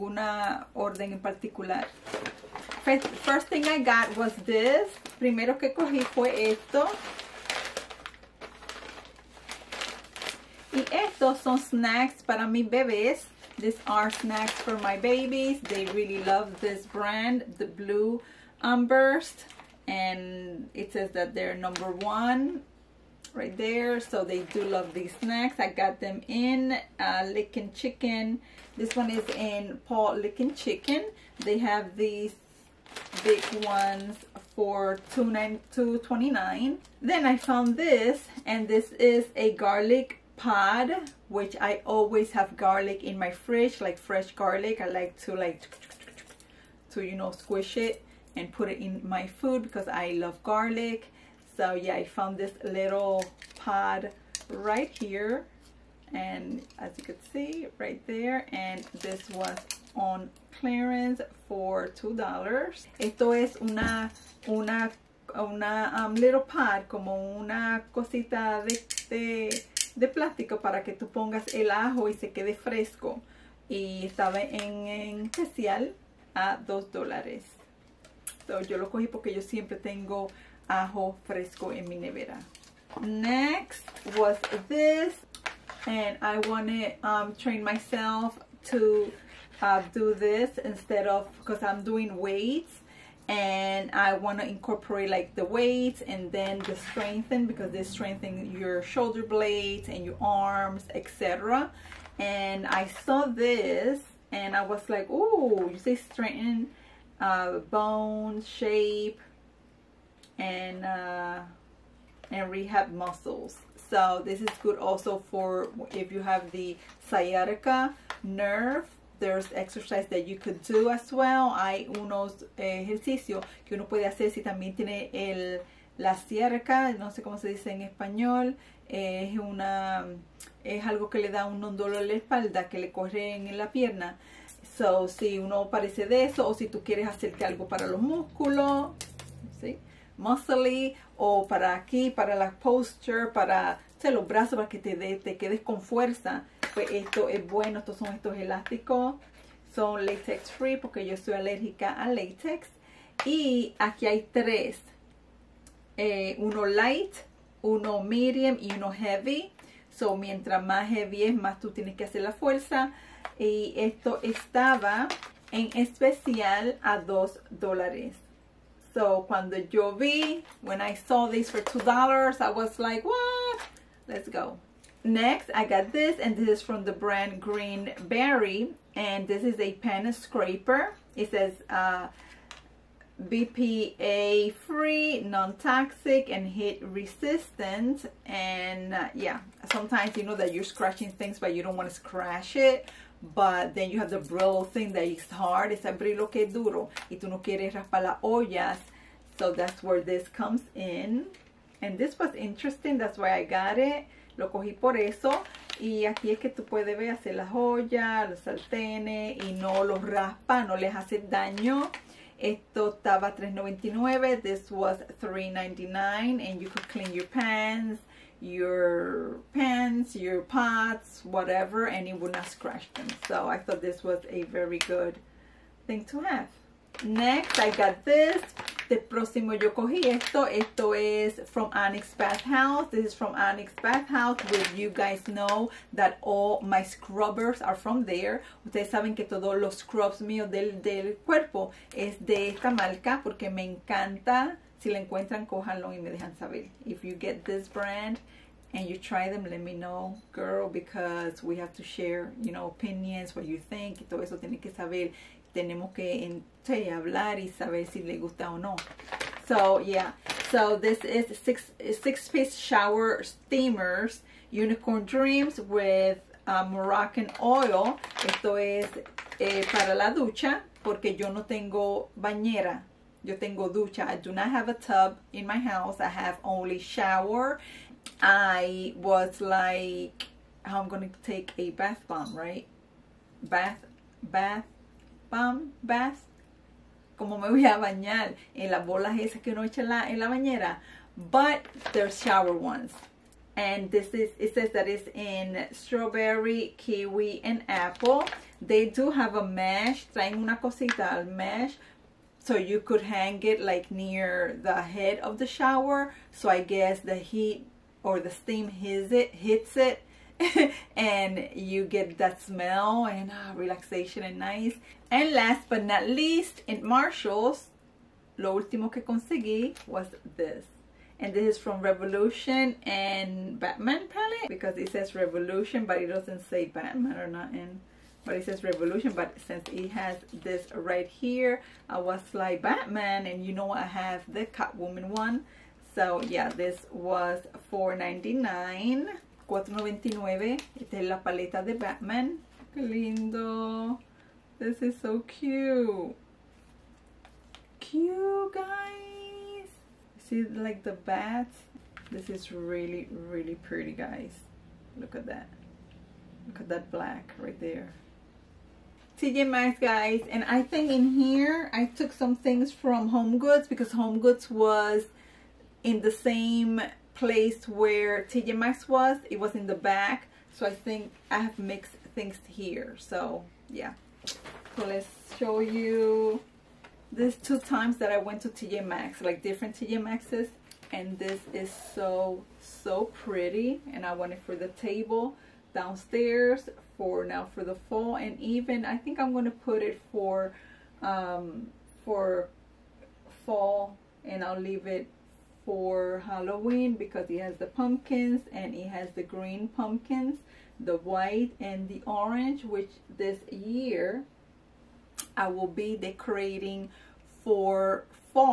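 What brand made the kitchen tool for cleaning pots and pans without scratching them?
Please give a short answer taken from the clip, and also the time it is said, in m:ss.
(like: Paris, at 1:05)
Green Berry, at 2:57.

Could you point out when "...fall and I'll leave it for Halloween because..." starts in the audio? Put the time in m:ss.
6:33.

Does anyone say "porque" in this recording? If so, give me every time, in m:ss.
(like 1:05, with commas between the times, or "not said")
1:19, 2:30, 4:03, 4:30.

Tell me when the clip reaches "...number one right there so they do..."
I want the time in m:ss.
0:21.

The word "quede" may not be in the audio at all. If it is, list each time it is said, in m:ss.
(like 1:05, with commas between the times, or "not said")
1:12, 2:25.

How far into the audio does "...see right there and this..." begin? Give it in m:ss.
0:57.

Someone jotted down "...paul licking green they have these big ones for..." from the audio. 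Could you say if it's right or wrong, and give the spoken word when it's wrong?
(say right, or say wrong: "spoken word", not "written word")
wrong: "chicken", not "green".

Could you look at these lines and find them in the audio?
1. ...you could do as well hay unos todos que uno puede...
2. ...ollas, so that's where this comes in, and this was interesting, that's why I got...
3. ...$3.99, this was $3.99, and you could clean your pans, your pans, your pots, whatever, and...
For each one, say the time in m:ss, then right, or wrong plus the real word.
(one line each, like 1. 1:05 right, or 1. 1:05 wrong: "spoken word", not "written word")
1. 2:00 wrong: "ejercicios", not "todos"
2. 3:18 right
3. 3:33 right.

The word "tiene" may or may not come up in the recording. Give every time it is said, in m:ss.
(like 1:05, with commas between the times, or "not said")
2:04, 2:41, 4:14.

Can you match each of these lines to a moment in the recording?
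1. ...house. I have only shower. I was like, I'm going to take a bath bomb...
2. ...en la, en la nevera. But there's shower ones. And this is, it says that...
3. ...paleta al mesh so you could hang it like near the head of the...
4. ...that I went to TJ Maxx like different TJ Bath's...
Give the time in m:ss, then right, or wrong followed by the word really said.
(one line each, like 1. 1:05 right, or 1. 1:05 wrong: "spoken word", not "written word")
1. 4:35 right
2. 4:49 wrong: "bañera", not "nevera"
3. 5:00 wrong: "cosita", not "paleta"
4. 6:17 wrong: "Maxx", not "Bath".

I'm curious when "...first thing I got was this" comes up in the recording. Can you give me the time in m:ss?
0:03.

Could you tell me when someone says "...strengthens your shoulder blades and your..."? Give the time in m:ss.
1:37.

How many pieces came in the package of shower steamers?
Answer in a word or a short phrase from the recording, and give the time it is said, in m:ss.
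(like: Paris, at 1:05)
6, at 4:21.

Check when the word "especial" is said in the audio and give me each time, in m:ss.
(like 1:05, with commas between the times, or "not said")
1:15, 2:45.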